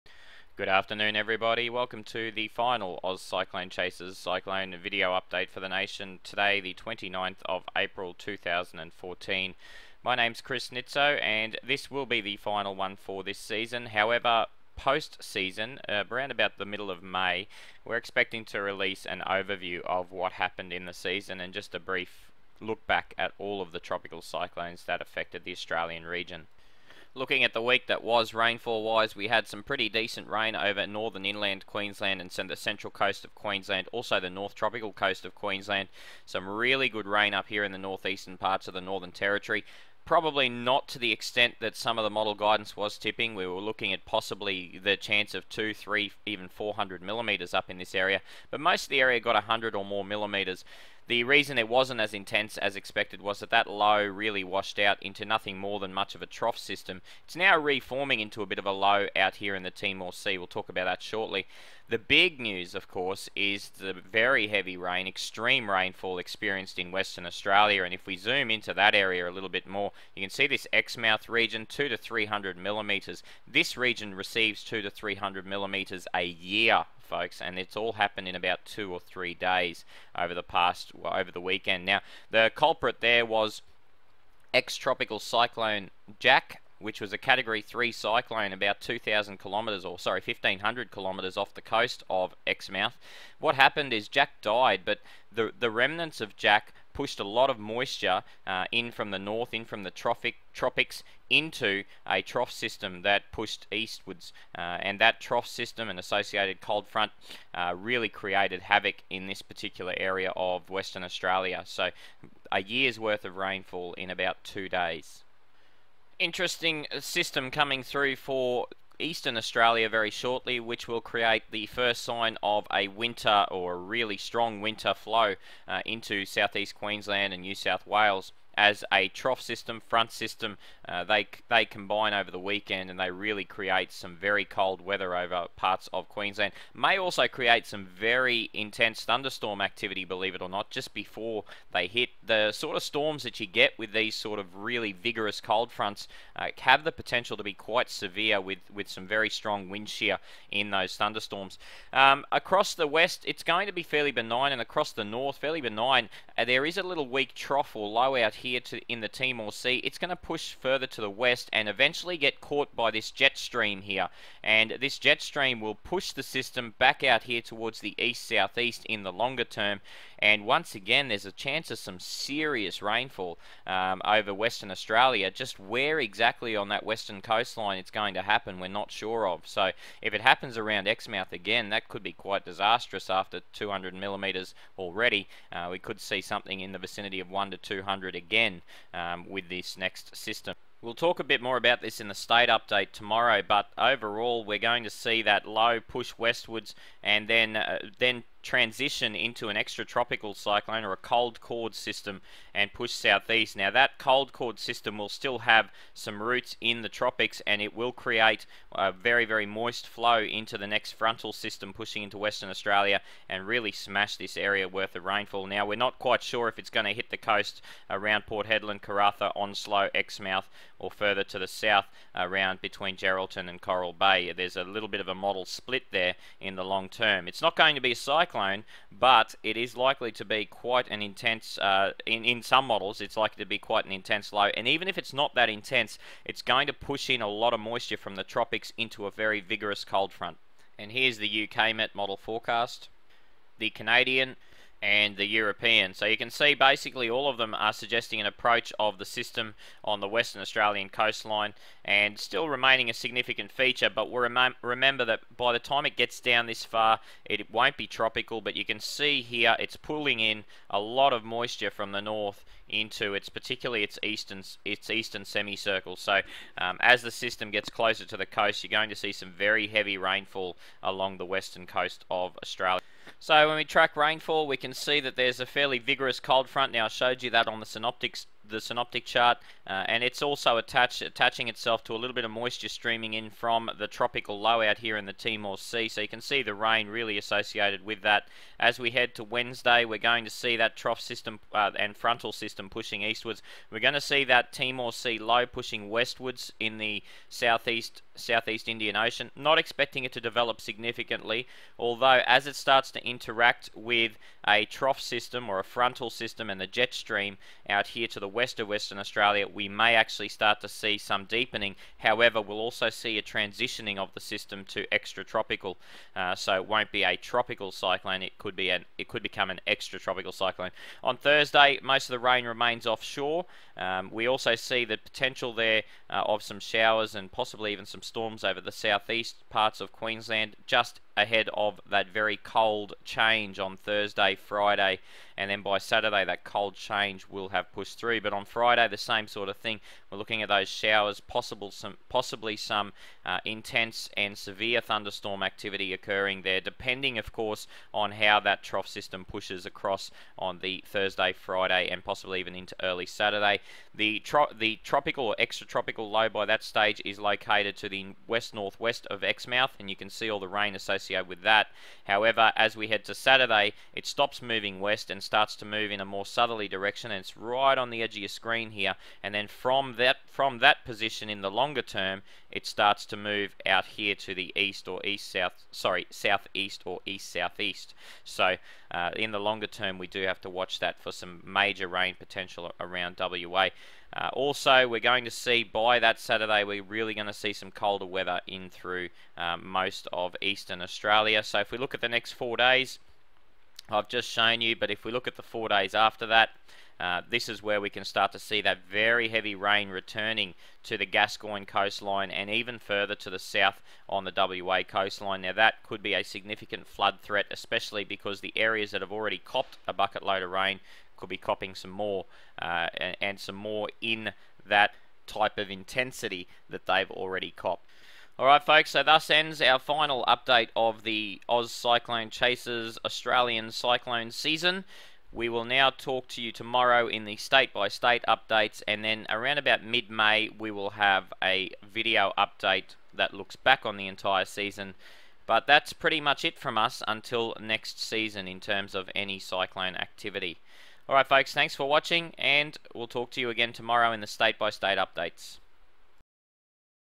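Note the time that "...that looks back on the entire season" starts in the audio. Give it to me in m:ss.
7:13.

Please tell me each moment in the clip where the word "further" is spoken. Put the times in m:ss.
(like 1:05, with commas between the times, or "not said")
2:40, 3:40, 6:42.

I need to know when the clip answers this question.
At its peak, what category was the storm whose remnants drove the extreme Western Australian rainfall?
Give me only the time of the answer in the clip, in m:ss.
1:27.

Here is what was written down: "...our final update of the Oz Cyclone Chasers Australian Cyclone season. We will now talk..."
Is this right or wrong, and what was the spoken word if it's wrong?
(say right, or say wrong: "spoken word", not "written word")
right.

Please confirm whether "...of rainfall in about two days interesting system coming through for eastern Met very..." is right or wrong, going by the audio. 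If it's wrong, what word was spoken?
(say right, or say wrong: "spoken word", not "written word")
wrong: "Australia", not "Met".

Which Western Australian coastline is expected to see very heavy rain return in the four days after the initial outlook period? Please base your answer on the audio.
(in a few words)
Gascoyne.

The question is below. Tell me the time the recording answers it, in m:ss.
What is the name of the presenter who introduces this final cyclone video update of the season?
0:10.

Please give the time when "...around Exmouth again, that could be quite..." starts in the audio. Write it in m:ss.
3:00.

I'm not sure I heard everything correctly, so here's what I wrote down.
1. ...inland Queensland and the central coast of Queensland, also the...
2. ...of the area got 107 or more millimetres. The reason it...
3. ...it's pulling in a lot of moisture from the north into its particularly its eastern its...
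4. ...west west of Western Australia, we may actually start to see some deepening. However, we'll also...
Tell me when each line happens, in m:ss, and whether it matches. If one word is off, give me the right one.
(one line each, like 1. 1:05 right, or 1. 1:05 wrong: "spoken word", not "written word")
1. 0:31 right
2. 0:48 wrong: "100", not "107"
3. 4:19 right
4. 5:08 right.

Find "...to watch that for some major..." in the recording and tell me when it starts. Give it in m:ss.
6:20.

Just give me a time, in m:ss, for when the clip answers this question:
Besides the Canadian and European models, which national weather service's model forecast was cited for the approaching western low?
4:01.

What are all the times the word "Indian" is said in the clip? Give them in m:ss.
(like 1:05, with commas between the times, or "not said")
4:58.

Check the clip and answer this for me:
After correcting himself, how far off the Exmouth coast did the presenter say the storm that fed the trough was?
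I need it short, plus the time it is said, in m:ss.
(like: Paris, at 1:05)
1,500 kilometres, at 1:30.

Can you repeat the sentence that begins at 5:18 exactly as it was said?
It could be an it could become an extratropical cyclone.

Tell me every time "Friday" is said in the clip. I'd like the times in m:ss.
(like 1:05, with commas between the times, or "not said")
5:34, 5:38, 5:51.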